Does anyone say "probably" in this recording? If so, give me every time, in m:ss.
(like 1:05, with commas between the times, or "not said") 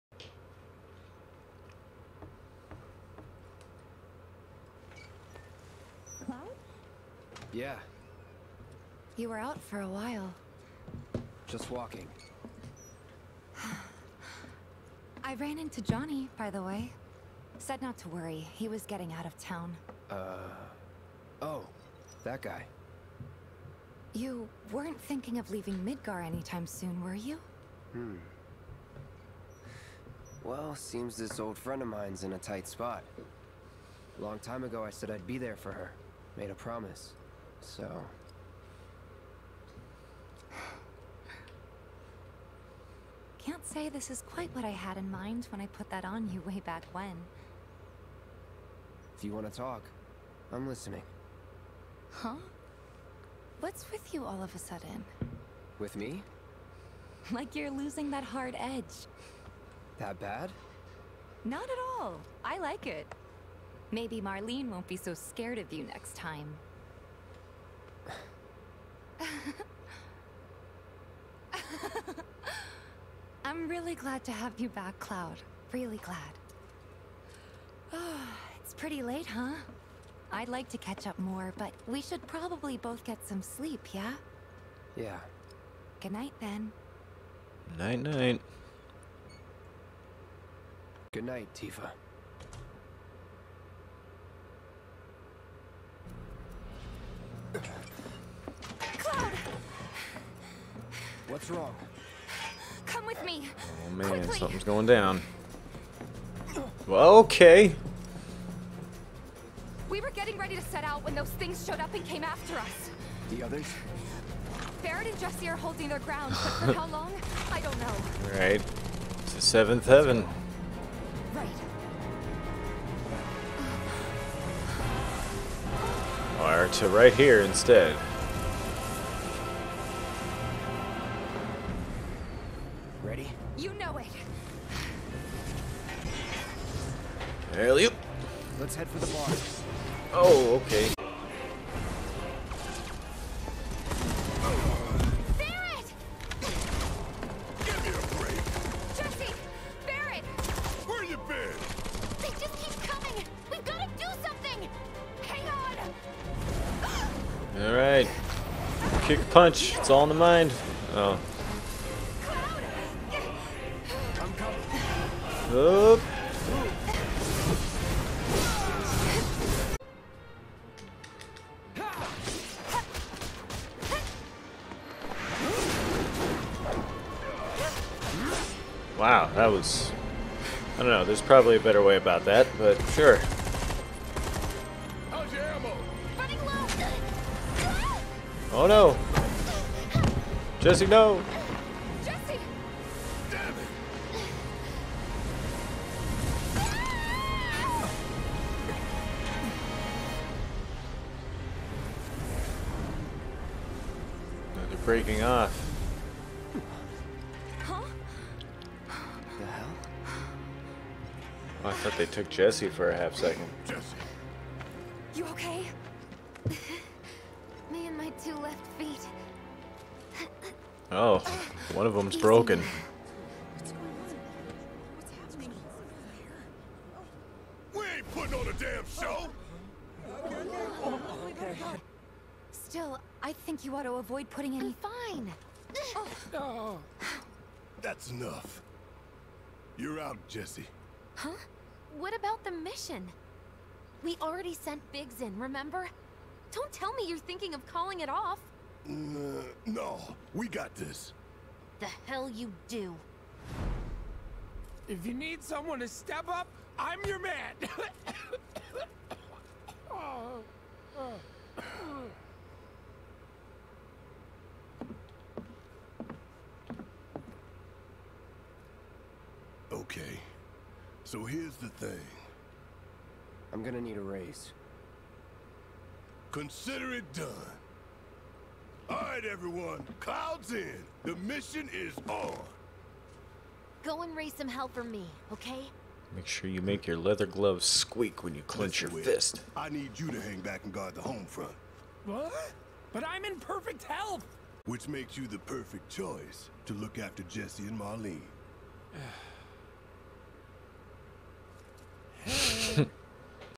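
1:22, 3:01.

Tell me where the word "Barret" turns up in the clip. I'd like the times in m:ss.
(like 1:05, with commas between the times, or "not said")
1:54, 2:25, 2:29.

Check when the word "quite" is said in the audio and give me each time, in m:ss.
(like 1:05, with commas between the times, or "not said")
0:44.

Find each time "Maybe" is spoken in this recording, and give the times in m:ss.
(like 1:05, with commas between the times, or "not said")
1:03.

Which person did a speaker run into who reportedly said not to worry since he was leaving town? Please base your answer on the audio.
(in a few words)
Johnny.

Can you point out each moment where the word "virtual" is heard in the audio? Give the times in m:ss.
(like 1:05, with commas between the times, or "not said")
not said.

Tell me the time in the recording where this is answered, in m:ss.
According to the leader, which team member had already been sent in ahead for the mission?
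4:04.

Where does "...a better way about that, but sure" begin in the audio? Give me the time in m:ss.
3:01.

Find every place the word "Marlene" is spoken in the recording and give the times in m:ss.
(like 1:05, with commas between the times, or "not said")
1:04, 4:57.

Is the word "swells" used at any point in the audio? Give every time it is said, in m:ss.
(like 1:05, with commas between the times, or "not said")
not said.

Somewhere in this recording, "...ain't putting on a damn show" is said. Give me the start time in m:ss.
3:47.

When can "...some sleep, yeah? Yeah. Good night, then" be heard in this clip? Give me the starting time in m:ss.
1:23.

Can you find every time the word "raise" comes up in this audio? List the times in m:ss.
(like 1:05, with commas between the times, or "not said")
4:34, 4:44.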